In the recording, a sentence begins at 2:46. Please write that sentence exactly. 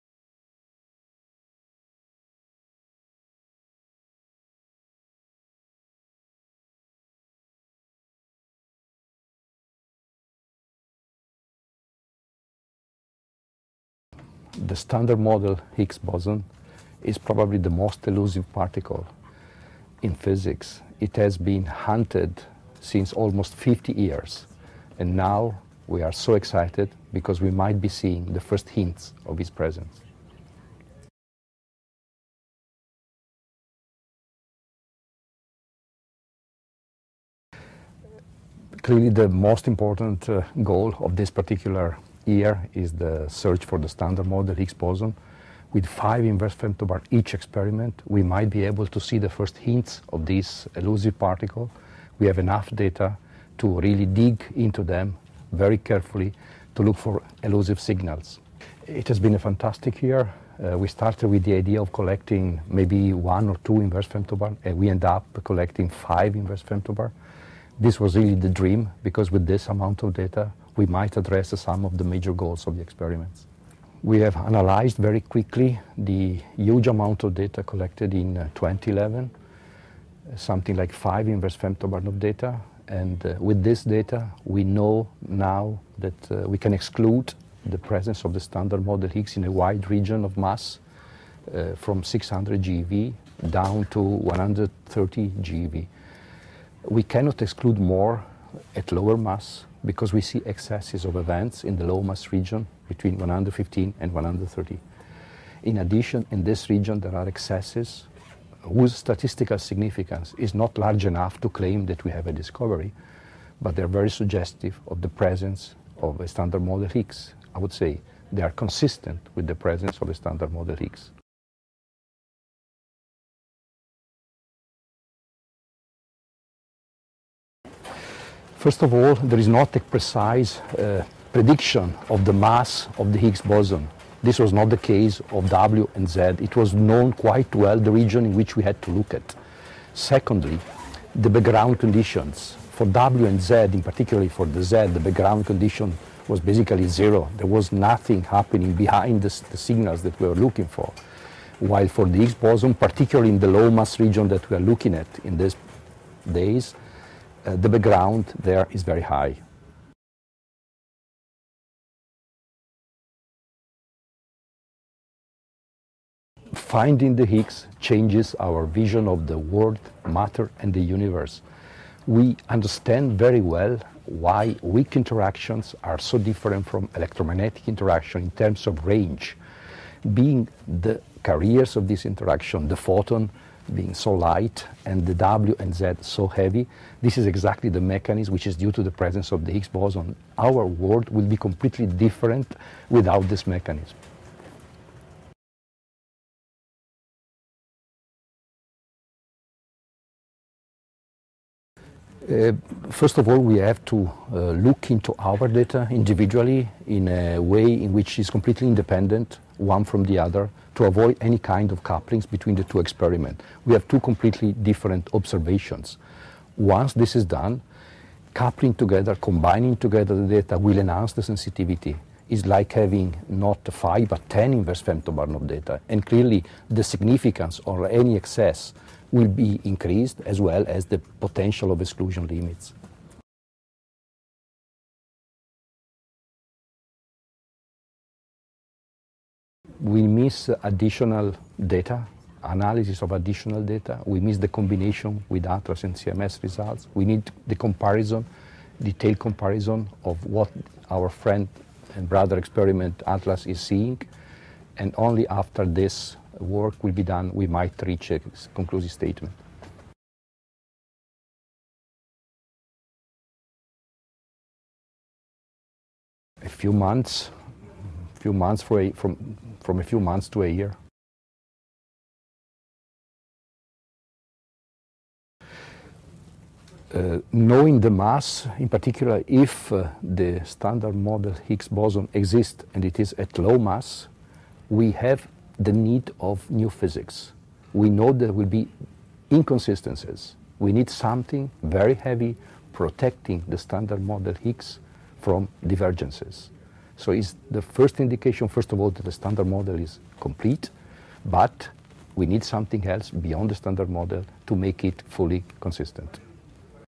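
Finding the Higgs changes our vision of the world, matter and the universe.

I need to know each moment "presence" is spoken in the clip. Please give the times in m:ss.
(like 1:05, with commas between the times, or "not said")
0:29, 1:27, 1:55, 1:59, 3:08.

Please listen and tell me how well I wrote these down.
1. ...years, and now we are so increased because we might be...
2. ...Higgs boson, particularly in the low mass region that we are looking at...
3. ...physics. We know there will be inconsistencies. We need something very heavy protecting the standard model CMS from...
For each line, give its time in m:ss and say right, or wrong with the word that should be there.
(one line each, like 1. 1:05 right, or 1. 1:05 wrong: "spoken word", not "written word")
1. 0:23 wrong: "excited", not "increased"
2. 2:32 right
3. 4:46 wrong: "Higgs", not "CMS".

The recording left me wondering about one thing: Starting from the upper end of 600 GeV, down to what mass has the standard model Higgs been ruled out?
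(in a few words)
130 GeV.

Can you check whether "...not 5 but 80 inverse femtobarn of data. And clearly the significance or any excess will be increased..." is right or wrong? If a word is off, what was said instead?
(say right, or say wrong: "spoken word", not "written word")
wrong: "10", not "80".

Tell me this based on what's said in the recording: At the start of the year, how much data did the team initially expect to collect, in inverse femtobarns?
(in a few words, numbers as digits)
1 or 2 inverse femtobarn.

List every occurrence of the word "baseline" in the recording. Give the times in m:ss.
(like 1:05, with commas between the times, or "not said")
not said.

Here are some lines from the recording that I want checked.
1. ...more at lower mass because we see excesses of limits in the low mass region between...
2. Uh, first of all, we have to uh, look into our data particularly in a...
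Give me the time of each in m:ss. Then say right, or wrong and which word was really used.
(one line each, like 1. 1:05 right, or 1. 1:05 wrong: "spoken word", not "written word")
1. 1:37 wrong: "events", not "limits"
2. 3:22 wrong: "individually", not "particularly".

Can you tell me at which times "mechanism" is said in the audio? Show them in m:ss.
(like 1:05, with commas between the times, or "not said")
3:07, 3:13.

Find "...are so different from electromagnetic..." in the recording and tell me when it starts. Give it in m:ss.
2:55.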